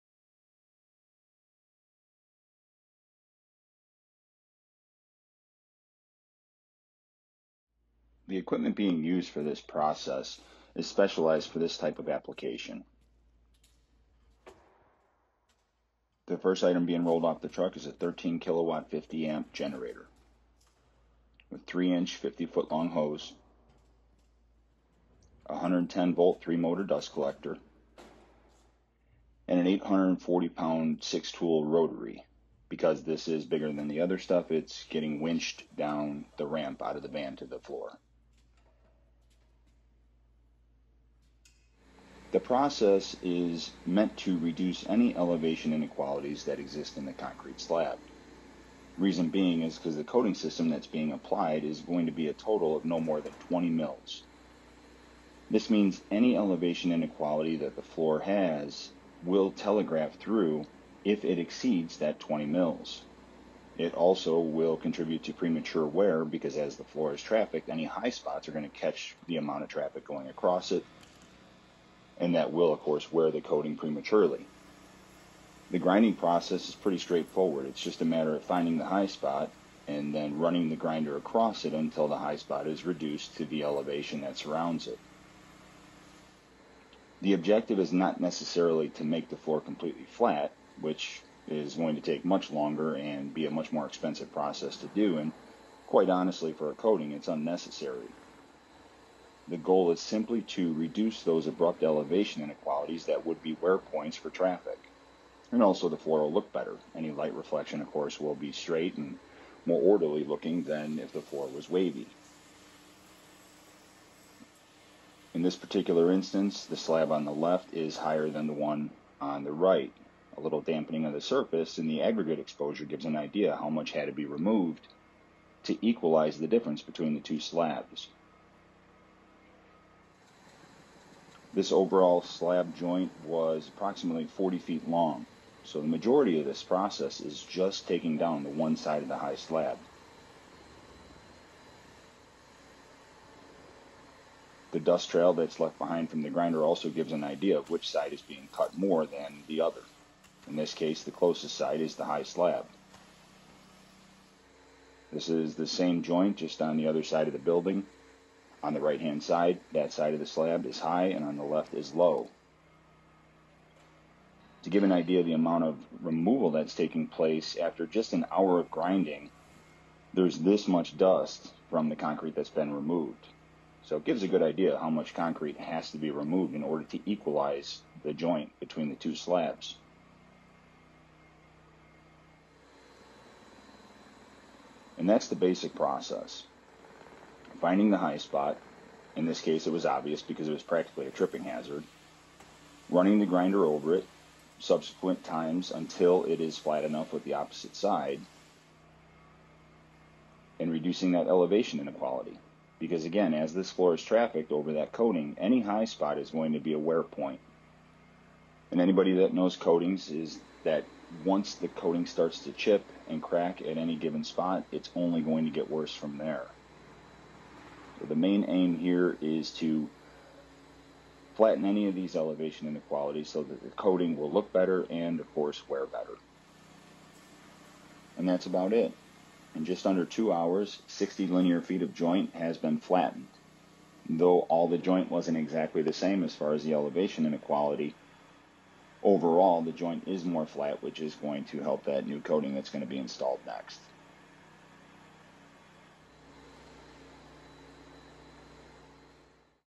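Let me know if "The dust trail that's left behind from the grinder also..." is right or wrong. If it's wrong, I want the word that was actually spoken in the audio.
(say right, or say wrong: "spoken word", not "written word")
right.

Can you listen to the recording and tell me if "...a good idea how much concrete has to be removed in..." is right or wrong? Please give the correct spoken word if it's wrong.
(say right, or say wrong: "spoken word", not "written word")
right.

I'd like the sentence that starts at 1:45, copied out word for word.
And also the floor will oh look better.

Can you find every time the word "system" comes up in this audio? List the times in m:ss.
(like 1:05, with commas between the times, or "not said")
0:50.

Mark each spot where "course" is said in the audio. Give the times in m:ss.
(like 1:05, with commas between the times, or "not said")
1:12, 1:47, 3:45.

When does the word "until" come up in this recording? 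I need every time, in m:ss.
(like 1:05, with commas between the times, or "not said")
1:21, 3:15.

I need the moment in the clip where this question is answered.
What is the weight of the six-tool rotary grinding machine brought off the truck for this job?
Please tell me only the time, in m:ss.
0:29.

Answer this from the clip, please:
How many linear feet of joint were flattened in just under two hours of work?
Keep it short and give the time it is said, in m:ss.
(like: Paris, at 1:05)
60, at 3:50.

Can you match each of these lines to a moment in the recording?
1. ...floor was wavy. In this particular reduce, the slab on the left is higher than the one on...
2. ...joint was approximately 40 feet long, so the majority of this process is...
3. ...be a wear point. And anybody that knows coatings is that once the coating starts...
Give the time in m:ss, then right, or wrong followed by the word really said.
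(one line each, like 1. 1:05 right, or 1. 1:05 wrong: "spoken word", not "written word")
1. 1:51 wrong: "instance", not "reduce"
2. 2:12 right
3. 3:26 right.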